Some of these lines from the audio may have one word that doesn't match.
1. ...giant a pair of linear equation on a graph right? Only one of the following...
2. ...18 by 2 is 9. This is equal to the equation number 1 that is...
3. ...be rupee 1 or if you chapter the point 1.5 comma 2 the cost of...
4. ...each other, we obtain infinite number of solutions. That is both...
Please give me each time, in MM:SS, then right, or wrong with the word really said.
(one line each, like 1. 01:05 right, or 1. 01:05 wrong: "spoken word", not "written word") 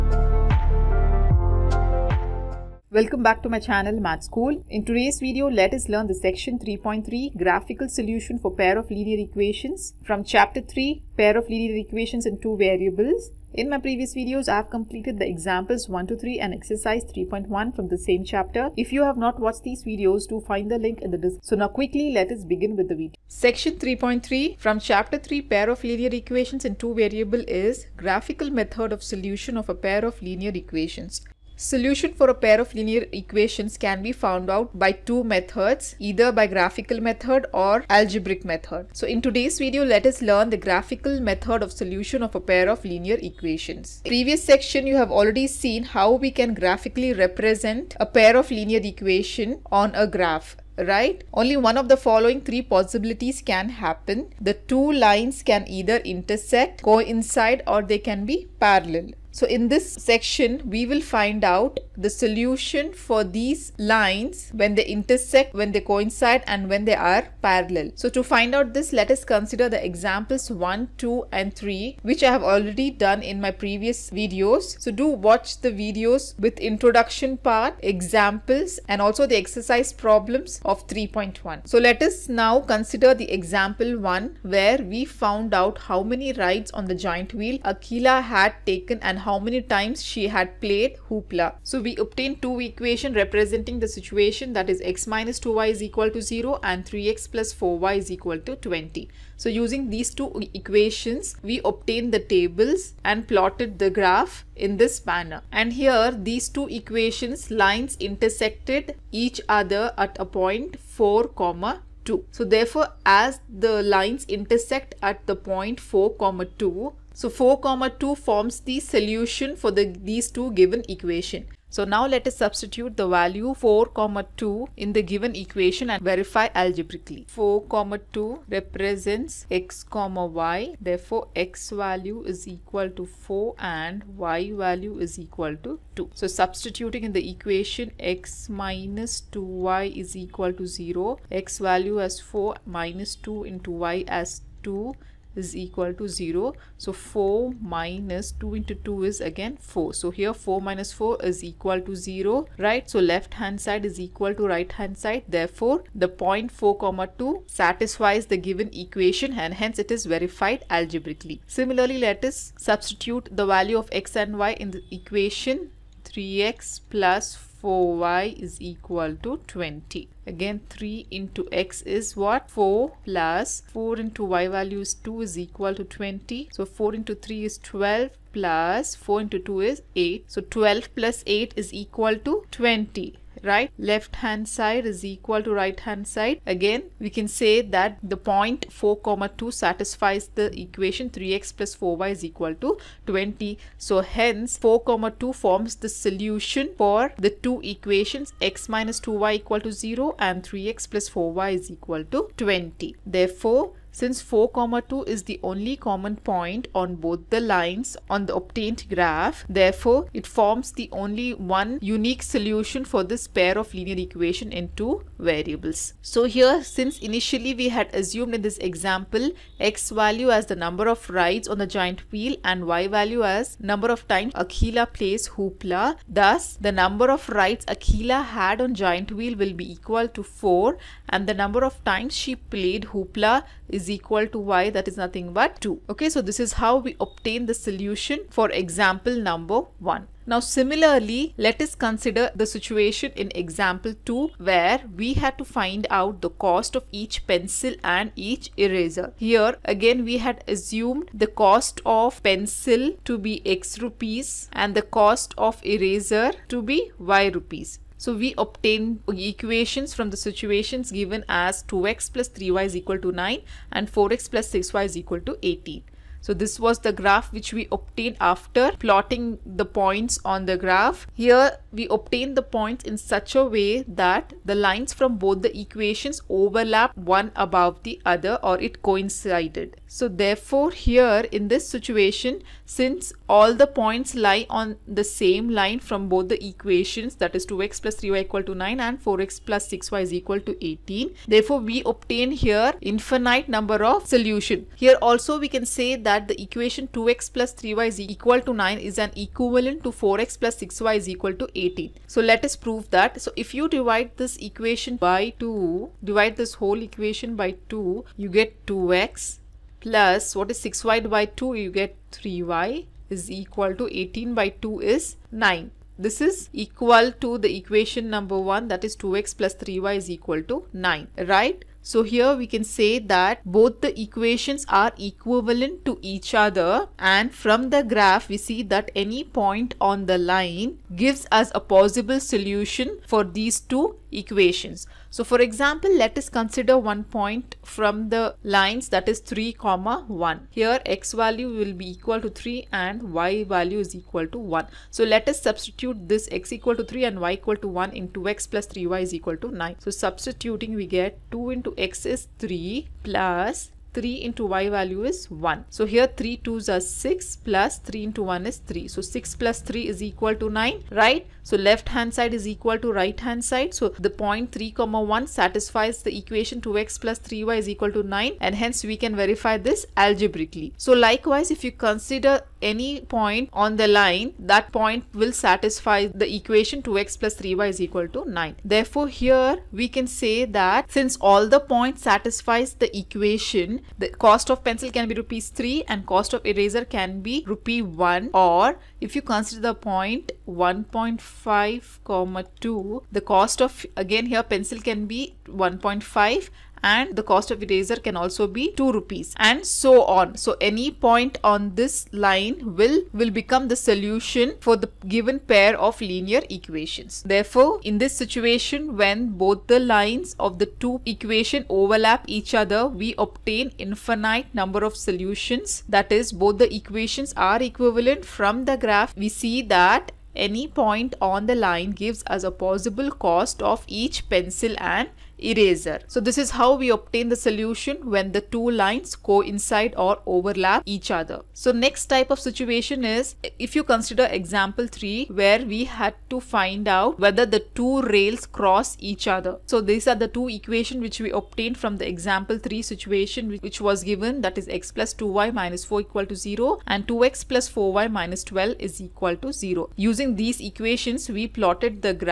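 1. 00:47 wrong: "represent", not "giant"
2. 05:13 right
3. 06:27 wrong: "consider", not "chapter"
4. 06:52 right.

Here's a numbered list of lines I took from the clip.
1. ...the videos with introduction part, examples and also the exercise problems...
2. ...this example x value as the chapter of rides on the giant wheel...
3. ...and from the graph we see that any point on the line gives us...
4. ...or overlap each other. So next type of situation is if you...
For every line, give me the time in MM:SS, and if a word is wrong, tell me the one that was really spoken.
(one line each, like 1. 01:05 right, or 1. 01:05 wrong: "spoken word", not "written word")
1. 01:15 right
2. 03:38 wrong: "number", not "chapter"
3. 05:26 right
4. 07:09 right.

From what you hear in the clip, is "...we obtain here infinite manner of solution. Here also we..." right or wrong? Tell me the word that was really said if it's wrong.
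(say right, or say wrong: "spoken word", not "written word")
wrong: "number", not "manner".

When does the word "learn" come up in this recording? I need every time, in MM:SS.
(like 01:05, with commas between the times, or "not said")
00:05, 00:40.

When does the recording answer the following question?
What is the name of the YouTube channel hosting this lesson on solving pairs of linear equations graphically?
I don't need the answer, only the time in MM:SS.
00:04.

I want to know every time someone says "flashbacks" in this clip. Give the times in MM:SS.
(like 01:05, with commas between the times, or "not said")
not said.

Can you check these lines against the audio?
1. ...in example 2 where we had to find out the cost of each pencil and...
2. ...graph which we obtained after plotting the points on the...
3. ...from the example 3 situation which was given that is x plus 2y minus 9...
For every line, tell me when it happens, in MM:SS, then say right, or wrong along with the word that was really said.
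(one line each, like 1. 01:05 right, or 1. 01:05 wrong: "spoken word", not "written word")
1. 04:03 right
2. 04:26 right
3. 07:21 wrong: "4", not "9".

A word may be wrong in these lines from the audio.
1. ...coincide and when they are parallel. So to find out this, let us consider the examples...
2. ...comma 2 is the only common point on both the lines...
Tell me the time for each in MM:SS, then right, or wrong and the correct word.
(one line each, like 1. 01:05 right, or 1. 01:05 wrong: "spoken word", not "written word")
1. 01:05 right
2. 03:24 right.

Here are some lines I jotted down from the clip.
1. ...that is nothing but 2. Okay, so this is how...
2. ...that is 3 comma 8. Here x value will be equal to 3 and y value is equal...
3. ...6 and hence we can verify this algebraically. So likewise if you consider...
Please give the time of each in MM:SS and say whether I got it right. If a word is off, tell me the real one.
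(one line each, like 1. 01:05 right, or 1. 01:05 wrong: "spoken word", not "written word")
1. 03:54 right
2. 05:38 wrong: "1", not "8"
3. 06:08 wrong: "9", not "6".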